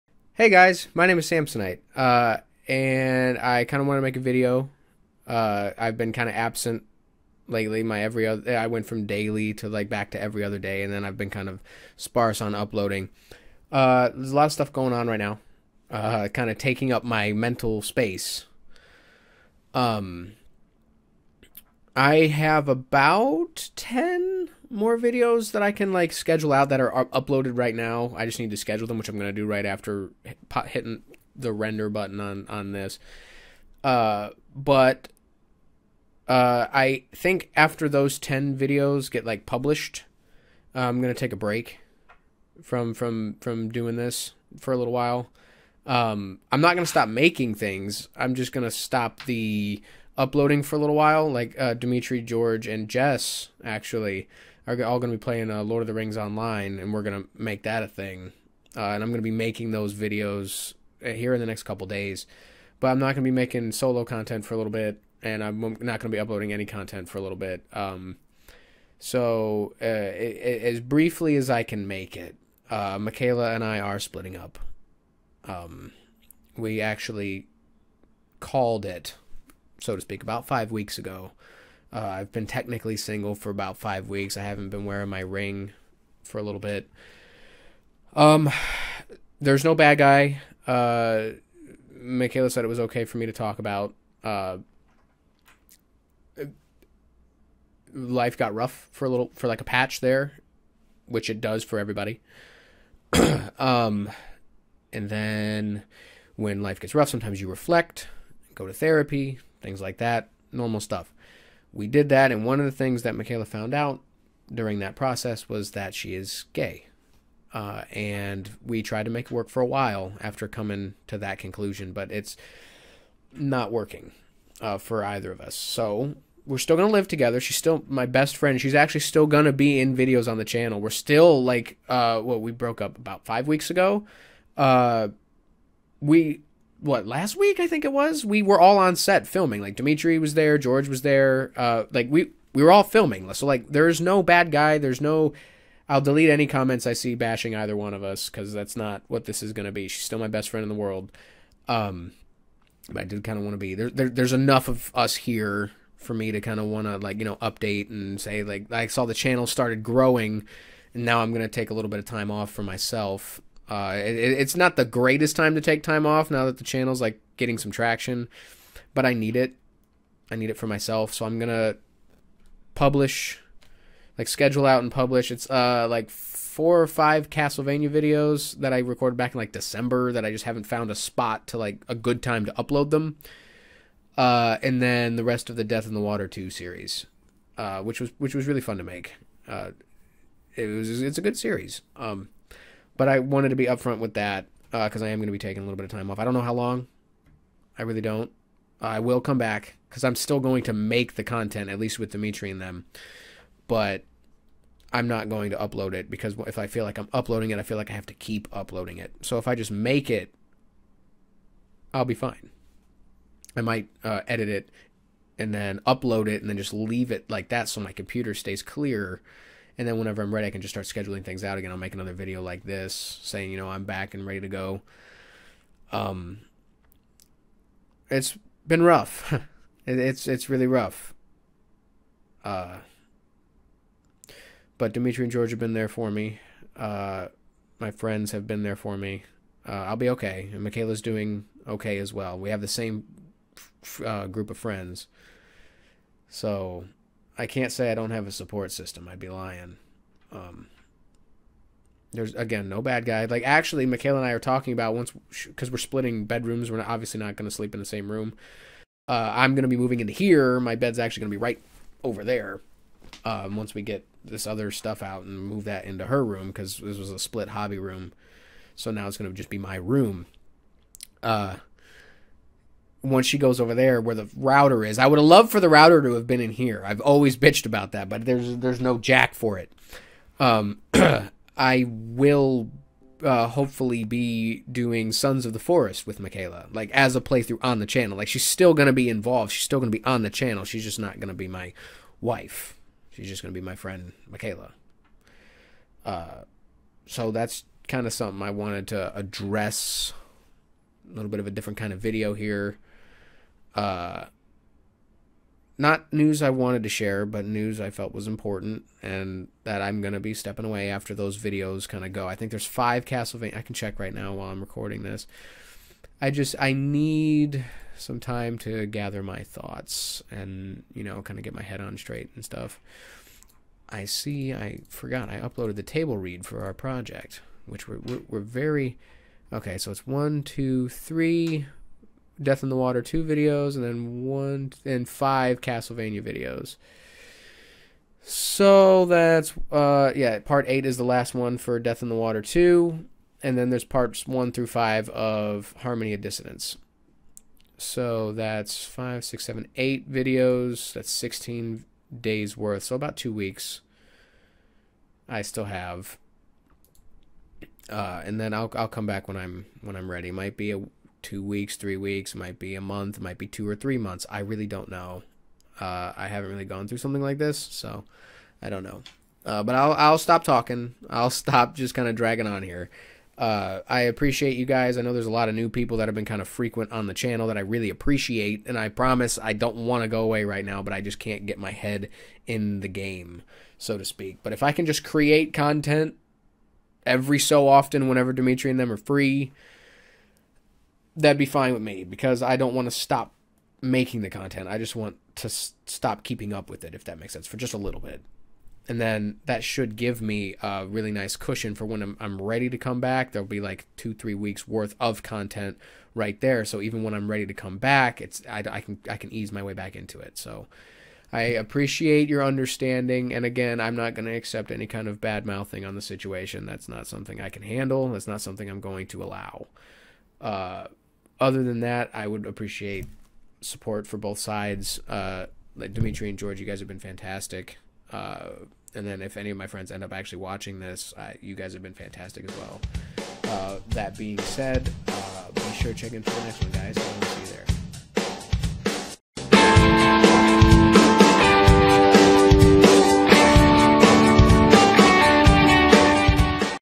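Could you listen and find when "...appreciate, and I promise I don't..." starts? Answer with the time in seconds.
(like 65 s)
377 s.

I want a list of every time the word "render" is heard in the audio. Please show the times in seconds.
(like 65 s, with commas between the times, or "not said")
31 s.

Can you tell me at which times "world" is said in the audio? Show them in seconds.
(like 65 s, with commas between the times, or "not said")
150 s.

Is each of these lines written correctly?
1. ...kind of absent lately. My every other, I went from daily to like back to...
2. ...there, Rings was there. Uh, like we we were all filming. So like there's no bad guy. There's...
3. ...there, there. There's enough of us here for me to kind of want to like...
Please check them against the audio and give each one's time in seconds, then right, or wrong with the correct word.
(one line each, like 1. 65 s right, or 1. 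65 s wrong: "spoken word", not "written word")
1. 6 s right
2. 140 s wrong: "George", not "Rings"
3. 153 s right.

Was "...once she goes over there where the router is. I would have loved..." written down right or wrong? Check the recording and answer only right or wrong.
right.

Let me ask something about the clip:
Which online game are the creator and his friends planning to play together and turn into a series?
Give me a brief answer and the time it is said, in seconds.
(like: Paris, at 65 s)
Lord of the Rings Online, at 55 s.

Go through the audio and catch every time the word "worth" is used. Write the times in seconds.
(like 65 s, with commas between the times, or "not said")
352 s, 404 s.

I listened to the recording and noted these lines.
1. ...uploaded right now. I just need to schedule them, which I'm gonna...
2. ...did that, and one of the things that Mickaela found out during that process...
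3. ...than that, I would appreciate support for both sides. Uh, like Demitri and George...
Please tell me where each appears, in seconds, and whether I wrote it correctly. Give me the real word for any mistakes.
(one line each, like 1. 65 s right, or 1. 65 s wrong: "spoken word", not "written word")
1. 27 s right
2. 111 s right
3. 421 s right.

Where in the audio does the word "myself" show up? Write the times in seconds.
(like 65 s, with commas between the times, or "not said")
162 s, 170 s.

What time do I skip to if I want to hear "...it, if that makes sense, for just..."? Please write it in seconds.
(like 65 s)
396 s.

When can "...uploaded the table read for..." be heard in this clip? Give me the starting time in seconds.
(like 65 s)
325 s.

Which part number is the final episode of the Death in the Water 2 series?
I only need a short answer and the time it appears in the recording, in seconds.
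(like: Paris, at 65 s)
8, at 340 s.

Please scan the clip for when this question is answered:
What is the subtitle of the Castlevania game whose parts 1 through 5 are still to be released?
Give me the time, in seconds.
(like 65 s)
345 s.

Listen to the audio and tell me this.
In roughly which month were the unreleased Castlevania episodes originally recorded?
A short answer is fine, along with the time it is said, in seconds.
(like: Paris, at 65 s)
December, at 179 s.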